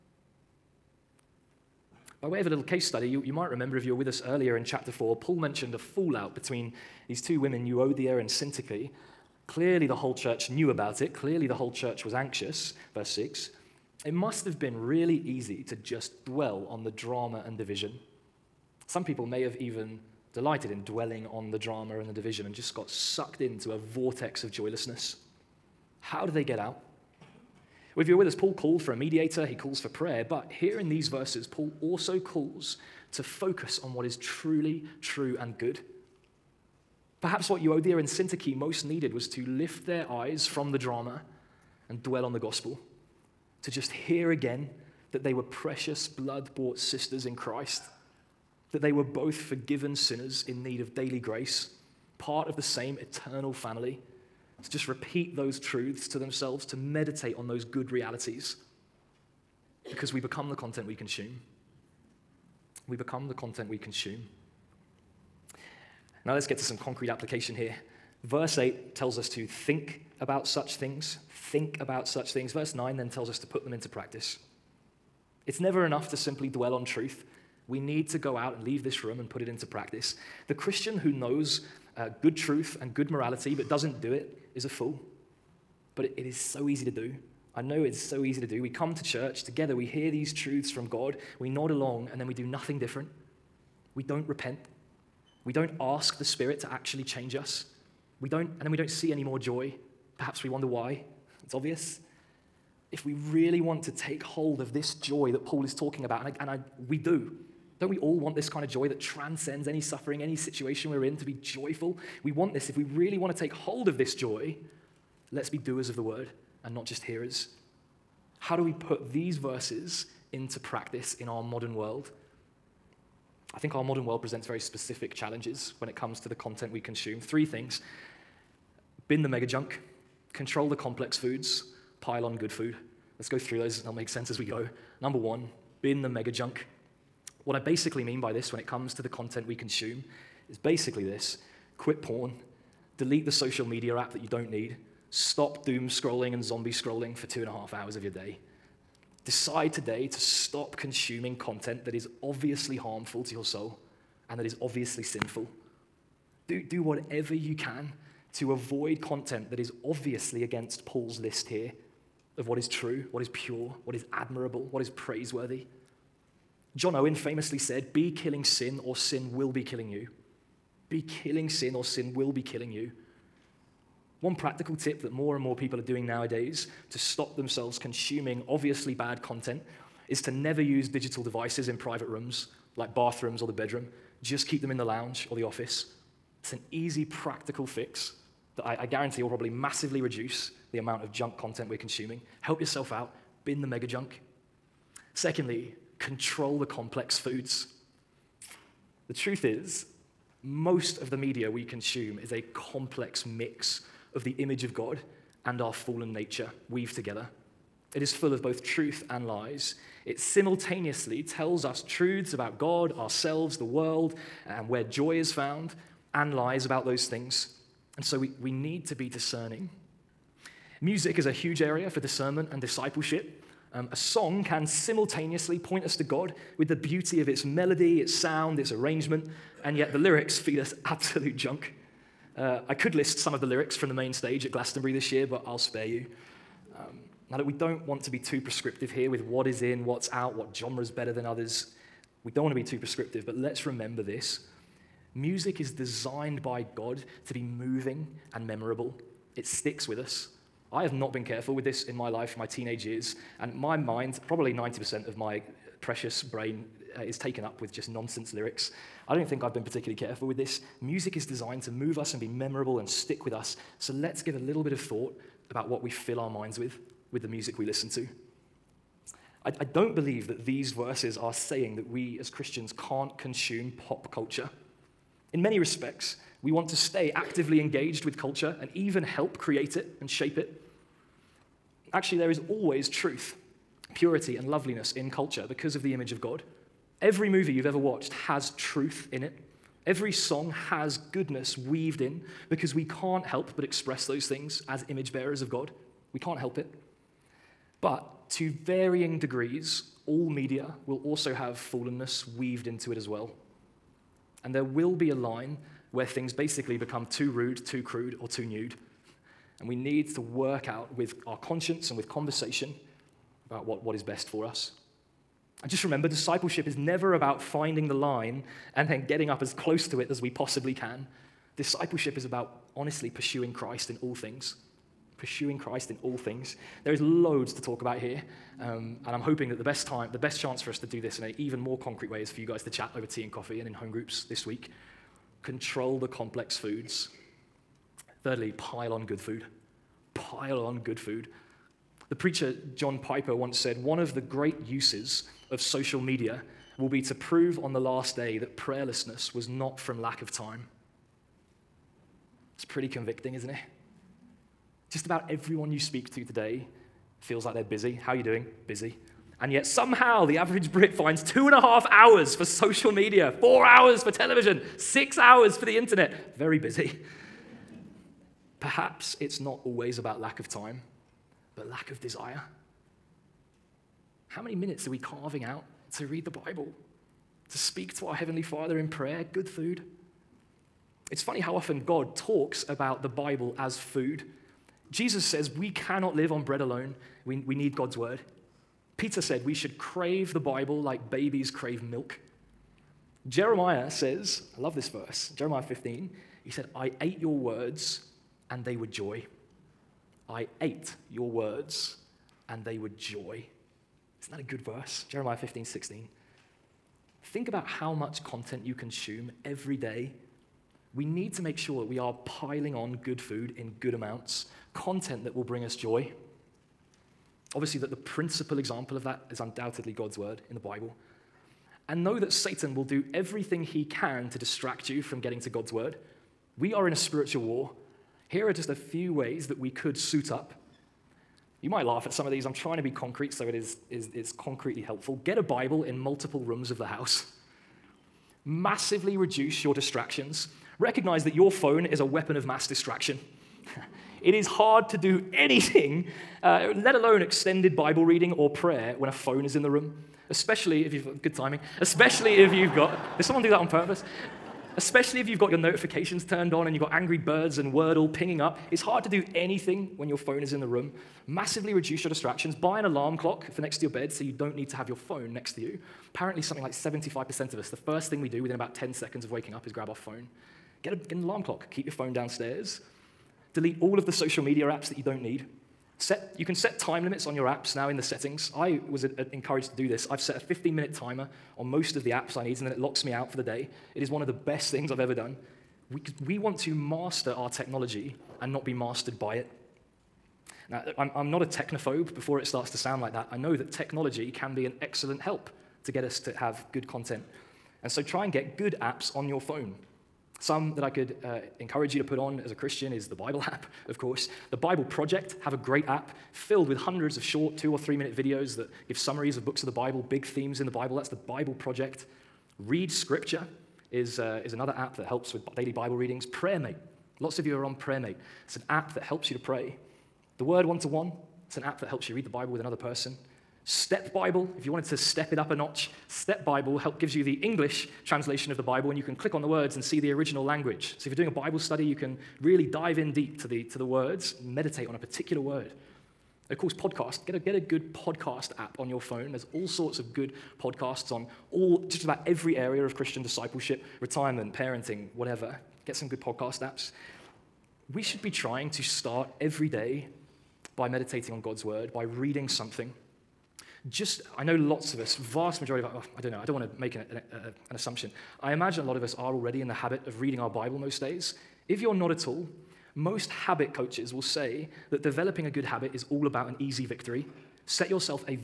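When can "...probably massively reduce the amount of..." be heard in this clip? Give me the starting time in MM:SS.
03:09.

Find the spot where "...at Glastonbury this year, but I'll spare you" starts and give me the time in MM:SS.
03:54.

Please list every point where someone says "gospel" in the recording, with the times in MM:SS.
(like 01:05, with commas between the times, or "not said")
00:42.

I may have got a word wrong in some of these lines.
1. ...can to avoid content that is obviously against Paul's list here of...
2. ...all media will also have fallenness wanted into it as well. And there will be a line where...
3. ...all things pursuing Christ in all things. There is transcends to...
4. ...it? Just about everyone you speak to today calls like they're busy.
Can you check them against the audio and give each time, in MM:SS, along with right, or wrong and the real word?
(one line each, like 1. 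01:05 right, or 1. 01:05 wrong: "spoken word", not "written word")
1. 02:37 right
2. 05:00 wrong: "weaved", not "wanted"
3. 05:24 wrong: "loads", not "transcends"
4. 05:53 wrong: "feels", not "calls".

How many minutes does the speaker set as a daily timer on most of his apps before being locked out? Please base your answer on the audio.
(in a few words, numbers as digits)
15 minutes.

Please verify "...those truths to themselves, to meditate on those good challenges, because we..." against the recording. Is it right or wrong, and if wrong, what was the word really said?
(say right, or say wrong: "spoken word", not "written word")
wrong: "realities", not "challenges".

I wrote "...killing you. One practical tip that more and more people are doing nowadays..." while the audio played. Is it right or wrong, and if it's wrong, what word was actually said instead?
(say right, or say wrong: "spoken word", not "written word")
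right.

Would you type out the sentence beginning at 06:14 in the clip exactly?
How many minutes are we carving out to read the Bible, to speak to our Heavenly Father in prayer, good food?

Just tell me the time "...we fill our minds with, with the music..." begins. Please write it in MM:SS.
04:25.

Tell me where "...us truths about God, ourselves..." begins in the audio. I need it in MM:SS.
03:31.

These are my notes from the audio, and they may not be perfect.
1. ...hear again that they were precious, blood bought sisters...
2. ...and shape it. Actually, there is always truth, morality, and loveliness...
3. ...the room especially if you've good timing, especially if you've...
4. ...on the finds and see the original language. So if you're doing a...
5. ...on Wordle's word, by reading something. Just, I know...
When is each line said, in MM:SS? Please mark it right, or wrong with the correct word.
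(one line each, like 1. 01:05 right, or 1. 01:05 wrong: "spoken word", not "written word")
1. 00:43 right
2. 04:40 wrong: "purity", not "morality"
3. 07:29 right
4. 08:49 wrong: "words", not "finds"
5. 09:11 wrong: "God", not "Wordle".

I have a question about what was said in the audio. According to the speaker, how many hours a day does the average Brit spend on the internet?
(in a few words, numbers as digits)
6 hours.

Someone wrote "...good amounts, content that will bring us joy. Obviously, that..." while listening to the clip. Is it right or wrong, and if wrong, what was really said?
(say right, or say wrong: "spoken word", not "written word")
right.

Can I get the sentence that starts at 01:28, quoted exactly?
We come to church together, we hear these truths from God, we nod along, and then we do nothing different.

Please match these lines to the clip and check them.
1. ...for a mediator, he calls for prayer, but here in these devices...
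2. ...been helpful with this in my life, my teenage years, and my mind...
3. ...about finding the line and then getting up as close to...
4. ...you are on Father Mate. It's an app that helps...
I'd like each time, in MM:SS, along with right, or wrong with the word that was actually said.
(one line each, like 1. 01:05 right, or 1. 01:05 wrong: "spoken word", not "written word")
1. 00:28 wrong: "verses", not "devices"
2. 04:11 wrong: "careful", not "helpful"
3. 05:17 right
4. 08:37 wrong: "Prayer", not "Father".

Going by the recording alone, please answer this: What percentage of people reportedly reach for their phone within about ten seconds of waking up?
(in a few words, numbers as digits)
75%.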